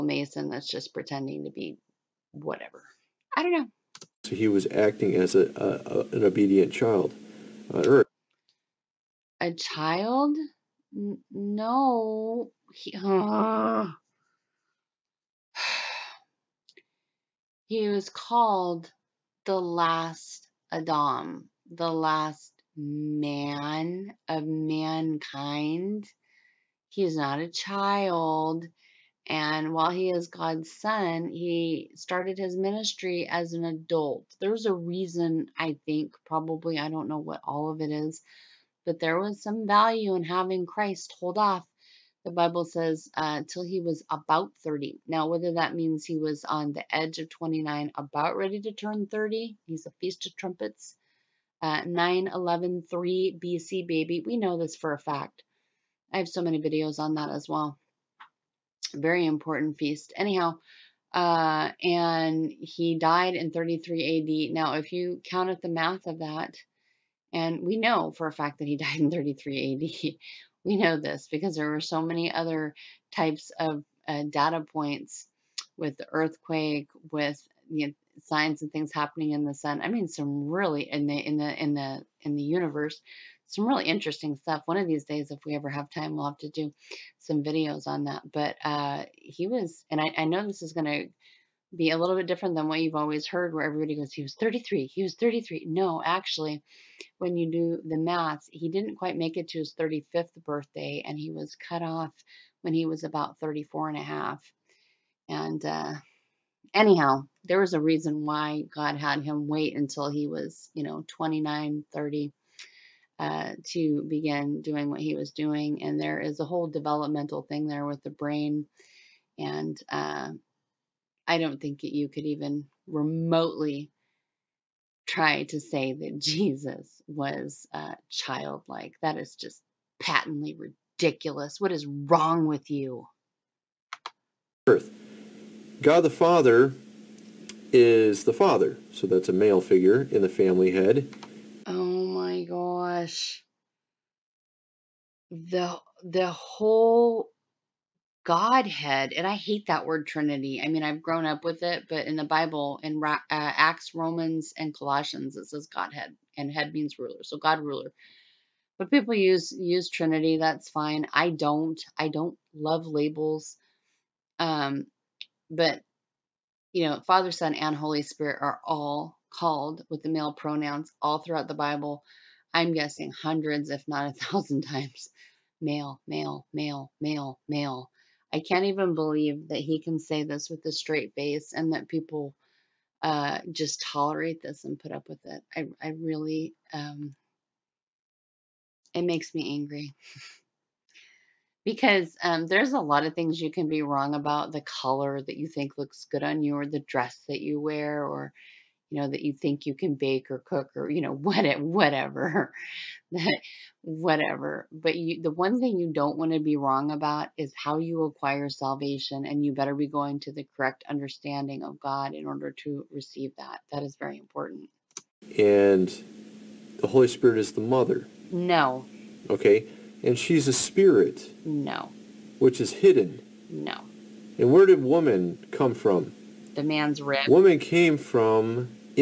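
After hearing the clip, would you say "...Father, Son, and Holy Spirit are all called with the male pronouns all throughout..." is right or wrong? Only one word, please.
right.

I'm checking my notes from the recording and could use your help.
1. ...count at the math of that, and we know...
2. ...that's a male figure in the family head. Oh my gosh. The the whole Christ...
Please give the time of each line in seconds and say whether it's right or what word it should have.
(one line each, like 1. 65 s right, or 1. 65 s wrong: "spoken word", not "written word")
1. 65 s right
2. 139 s wrong: "Godhead", not "Christ".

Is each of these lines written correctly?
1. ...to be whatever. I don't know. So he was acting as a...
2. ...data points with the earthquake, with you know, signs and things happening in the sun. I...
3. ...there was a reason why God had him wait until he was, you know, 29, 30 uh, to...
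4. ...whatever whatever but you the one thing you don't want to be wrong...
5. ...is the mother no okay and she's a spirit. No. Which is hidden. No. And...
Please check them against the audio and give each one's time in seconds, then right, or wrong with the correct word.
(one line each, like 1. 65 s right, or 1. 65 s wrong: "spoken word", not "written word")
1. 1 s right
2. 74 s right
3. 107 s right
4. 201 s right
5. 217 s right.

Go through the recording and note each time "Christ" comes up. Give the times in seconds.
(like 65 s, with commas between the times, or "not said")
40 s.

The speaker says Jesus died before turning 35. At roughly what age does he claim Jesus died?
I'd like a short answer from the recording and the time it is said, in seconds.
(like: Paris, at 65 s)
34 and a half, at 103 s.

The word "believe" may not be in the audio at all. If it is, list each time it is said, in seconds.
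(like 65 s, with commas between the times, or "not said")
178 s.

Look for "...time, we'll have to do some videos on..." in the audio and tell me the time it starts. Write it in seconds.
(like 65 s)
85 s.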